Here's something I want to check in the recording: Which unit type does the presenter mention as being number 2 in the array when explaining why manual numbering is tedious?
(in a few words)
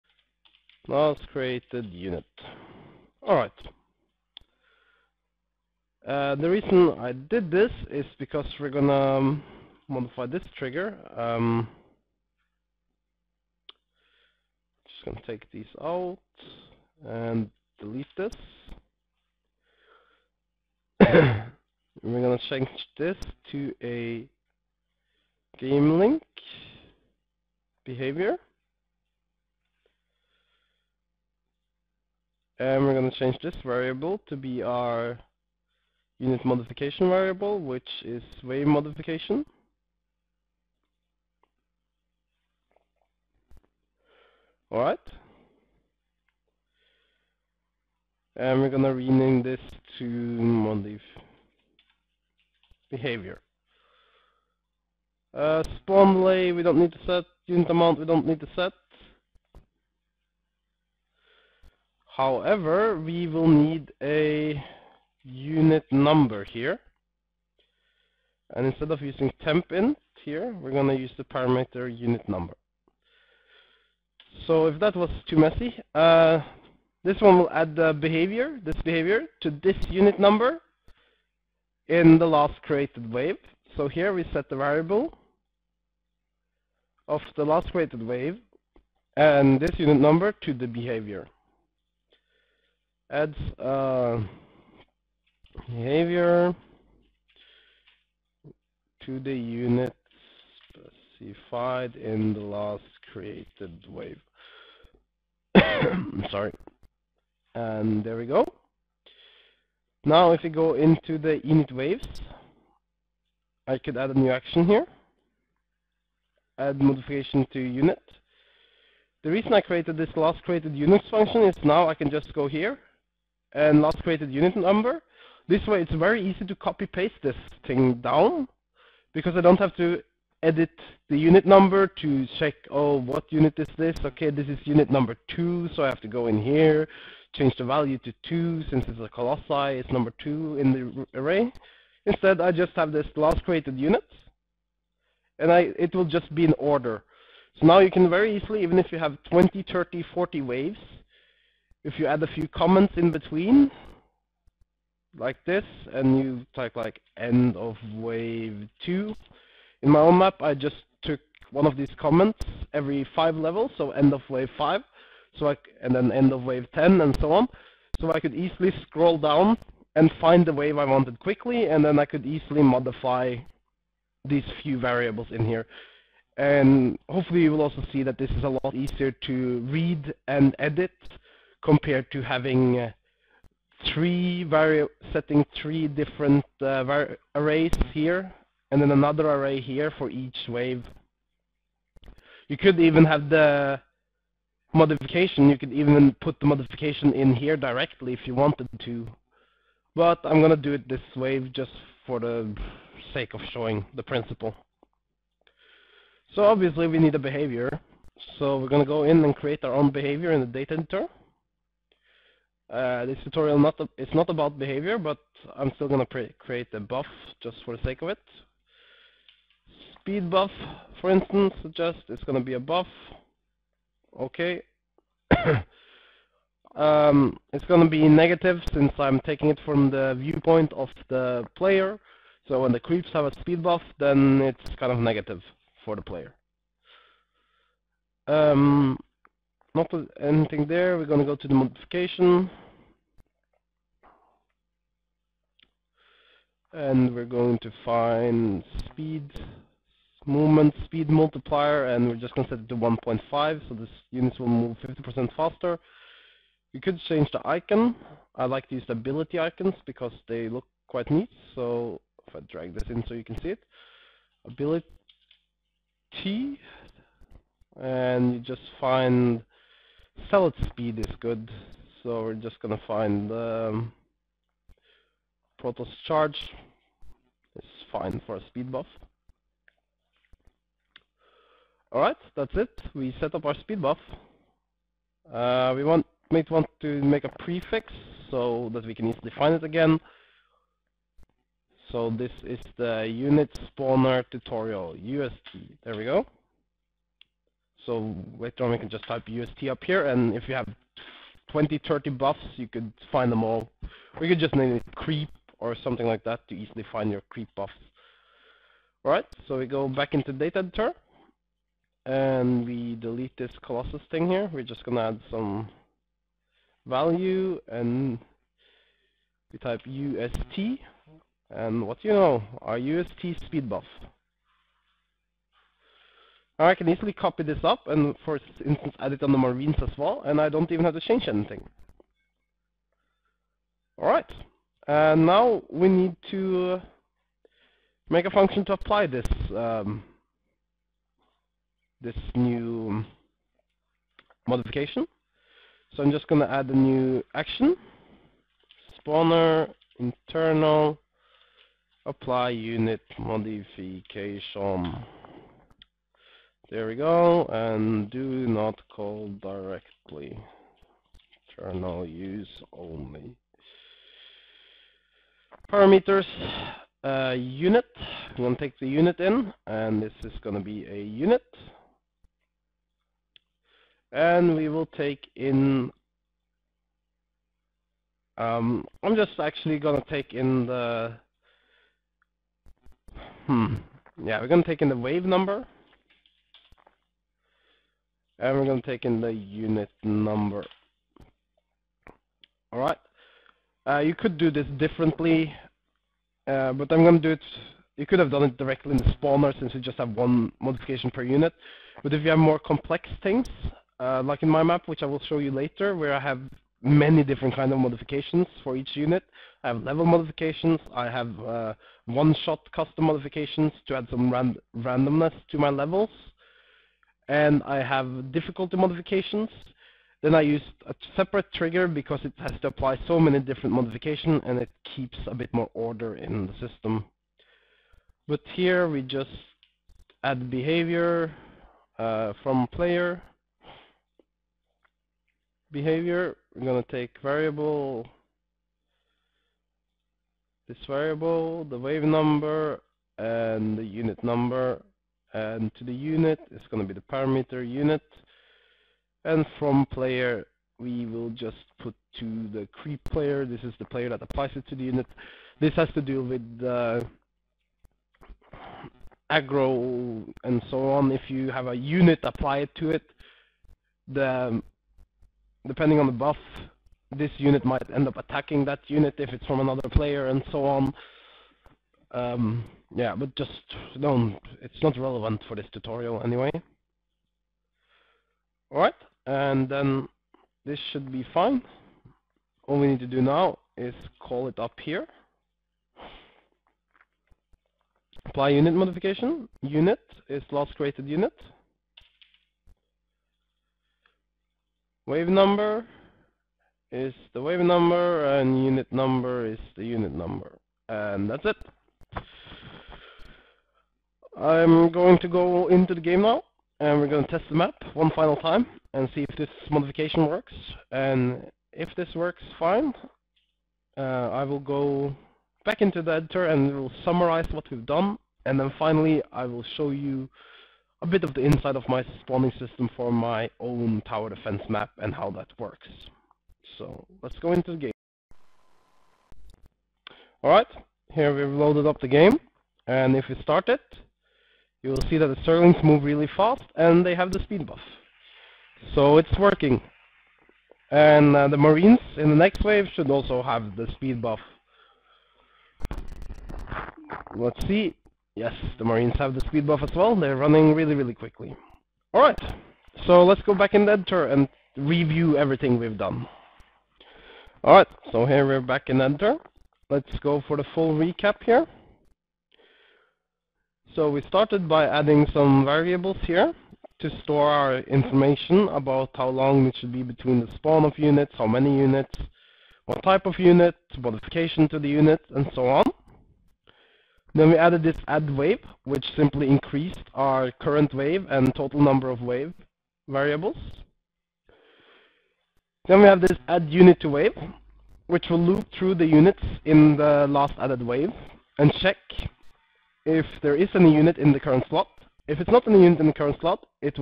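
Colossi.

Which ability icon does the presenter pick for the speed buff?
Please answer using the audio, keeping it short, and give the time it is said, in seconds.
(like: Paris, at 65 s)
Protoss charge, at 275 s.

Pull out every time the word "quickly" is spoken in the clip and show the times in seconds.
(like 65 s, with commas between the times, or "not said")
171 s, 551 s.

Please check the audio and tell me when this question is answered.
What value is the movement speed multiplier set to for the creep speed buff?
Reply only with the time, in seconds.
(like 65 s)
252 s.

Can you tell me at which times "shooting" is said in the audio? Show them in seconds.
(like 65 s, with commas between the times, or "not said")
not said.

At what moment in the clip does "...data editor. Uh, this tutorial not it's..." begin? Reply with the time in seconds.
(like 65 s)
210 s.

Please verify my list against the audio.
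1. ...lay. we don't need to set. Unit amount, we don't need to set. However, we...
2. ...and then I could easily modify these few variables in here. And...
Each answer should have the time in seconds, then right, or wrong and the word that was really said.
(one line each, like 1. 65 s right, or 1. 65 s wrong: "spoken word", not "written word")
1. 56 s right
2. 171 s right.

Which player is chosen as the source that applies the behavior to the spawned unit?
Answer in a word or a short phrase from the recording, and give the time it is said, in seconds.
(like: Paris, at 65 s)
creep player, at 452 s.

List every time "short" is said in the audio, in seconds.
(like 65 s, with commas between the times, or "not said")
not said.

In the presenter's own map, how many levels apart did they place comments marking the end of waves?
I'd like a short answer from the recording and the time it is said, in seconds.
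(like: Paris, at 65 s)
5, at 162 s.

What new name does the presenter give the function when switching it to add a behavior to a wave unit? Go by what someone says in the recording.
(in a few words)
modif behavior.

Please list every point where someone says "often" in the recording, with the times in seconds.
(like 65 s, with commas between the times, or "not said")
not said.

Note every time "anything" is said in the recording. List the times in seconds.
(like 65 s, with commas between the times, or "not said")
240 s, 331 s.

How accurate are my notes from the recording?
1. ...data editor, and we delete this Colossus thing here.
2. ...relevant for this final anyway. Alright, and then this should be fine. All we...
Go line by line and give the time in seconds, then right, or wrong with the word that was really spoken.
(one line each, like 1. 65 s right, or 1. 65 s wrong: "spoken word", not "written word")
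1. 310 s right
2. 474 s wrong: "tutorial", not "final".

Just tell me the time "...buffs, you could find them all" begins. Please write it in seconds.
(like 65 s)
302 s.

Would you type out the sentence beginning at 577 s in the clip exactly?
Then we added this add wave, which simply increased our current wave and total number of wave variables.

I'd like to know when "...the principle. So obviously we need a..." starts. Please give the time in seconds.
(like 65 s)
203 s.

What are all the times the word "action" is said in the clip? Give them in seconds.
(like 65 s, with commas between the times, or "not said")
114 s, 347 s.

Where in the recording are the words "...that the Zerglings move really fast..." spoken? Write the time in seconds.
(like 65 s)
535 s.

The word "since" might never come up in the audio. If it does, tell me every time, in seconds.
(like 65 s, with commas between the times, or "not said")
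138 s, 228 s, 399 s.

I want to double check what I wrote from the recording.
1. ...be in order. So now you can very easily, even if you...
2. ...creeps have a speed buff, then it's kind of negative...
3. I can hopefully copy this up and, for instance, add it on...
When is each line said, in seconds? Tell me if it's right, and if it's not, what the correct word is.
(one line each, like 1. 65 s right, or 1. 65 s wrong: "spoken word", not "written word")
1. 146 s right
2. 232 s right
3. 326 s wrong: "easily", not "hopefully".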